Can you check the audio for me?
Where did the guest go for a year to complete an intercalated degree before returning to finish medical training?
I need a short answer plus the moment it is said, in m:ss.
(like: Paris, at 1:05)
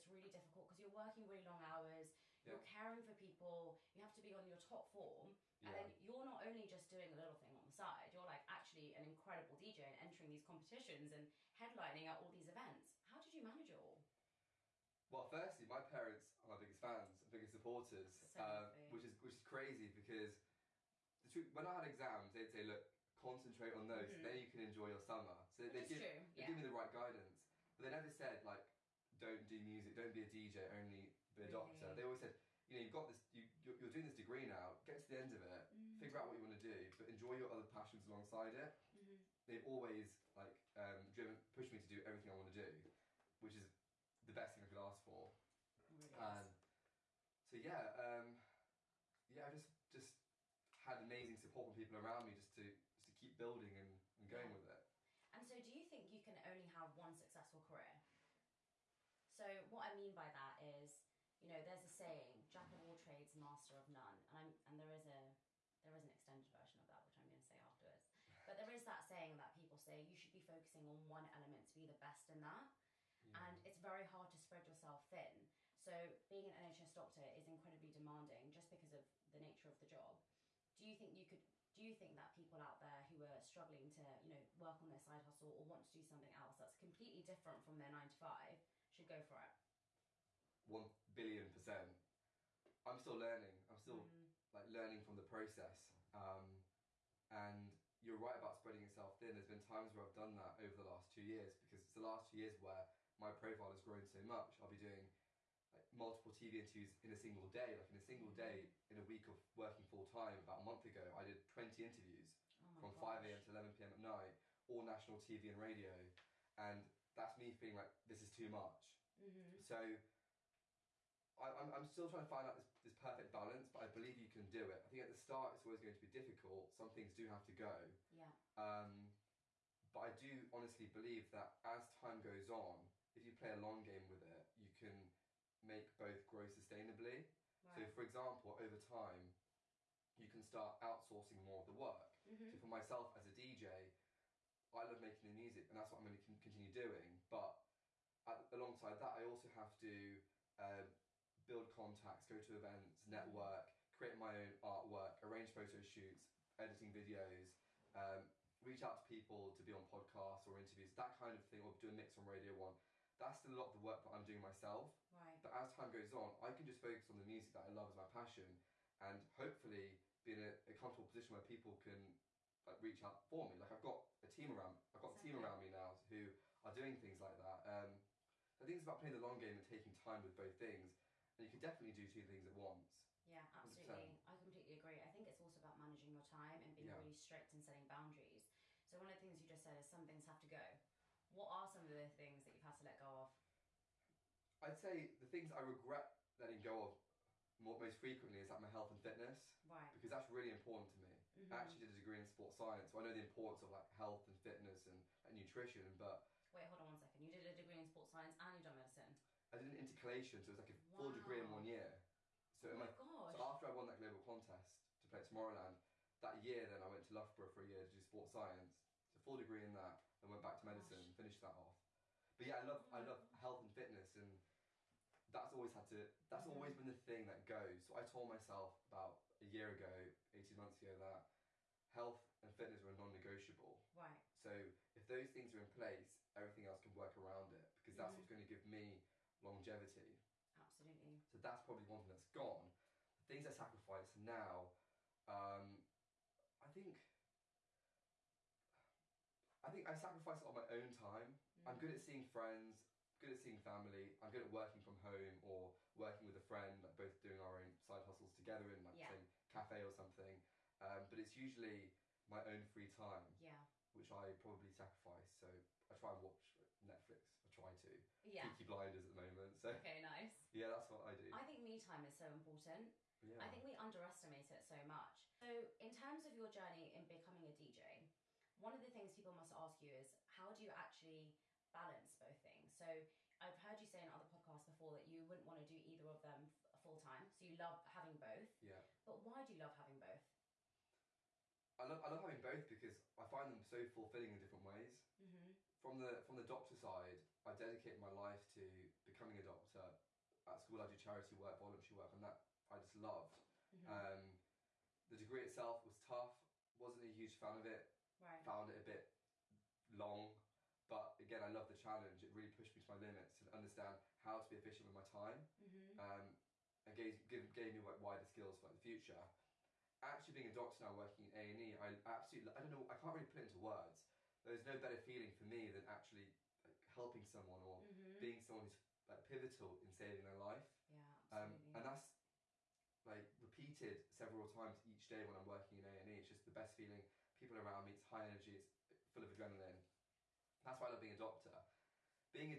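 Loughborough, at 3:37.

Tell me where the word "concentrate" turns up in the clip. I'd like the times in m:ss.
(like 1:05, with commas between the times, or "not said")
0:23.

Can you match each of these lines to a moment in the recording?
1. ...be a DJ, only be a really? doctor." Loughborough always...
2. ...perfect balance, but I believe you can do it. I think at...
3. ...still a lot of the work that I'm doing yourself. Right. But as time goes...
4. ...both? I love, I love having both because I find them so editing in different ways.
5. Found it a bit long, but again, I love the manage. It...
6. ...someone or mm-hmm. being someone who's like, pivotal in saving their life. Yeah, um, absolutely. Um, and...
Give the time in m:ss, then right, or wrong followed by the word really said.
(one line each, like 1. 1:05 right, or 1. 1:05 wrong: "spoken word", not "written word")
1. 0:30 wrong: "They", not "Loughborough"
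2. 2:02 right
3. 2:43 wrong: "myself", not "yourself"
4. 4:49 wrong: "fulfilling", not "editing"
5. 5:08 wrong: "challenge", not "manage"
6. 5:27 right.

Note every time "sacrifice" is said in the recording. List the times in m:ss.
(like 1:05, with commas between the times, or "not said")
4:03, 4:09, 4:24.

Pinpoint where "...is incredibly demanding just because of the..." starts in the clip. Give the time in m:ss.
1:17.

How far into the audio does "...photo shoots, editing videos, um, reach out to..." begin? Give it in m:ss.
2:35.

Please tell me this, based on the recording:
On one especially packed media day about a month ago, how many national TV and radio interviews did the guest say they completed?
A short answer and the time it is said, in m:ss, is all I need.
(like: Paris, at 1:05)
20, at 1:51.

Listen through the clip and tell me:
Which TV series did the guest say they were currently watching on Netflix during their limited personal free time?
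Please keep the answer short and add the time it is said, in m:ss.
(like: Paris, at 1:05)
Peaky Blinders, at 4:28.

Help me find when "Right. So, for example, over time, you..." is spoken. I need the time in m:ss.
2:17.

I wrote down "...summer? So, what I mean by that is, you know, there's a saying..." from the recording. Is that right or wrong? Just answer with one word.
wrong.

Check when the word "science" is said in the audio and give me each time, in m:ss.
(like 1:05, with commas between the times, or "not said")
3:22, 3:28, 3:38.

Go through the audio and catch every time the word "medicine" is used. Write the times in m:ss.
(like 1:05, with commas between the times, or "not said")
3:28, 3:40.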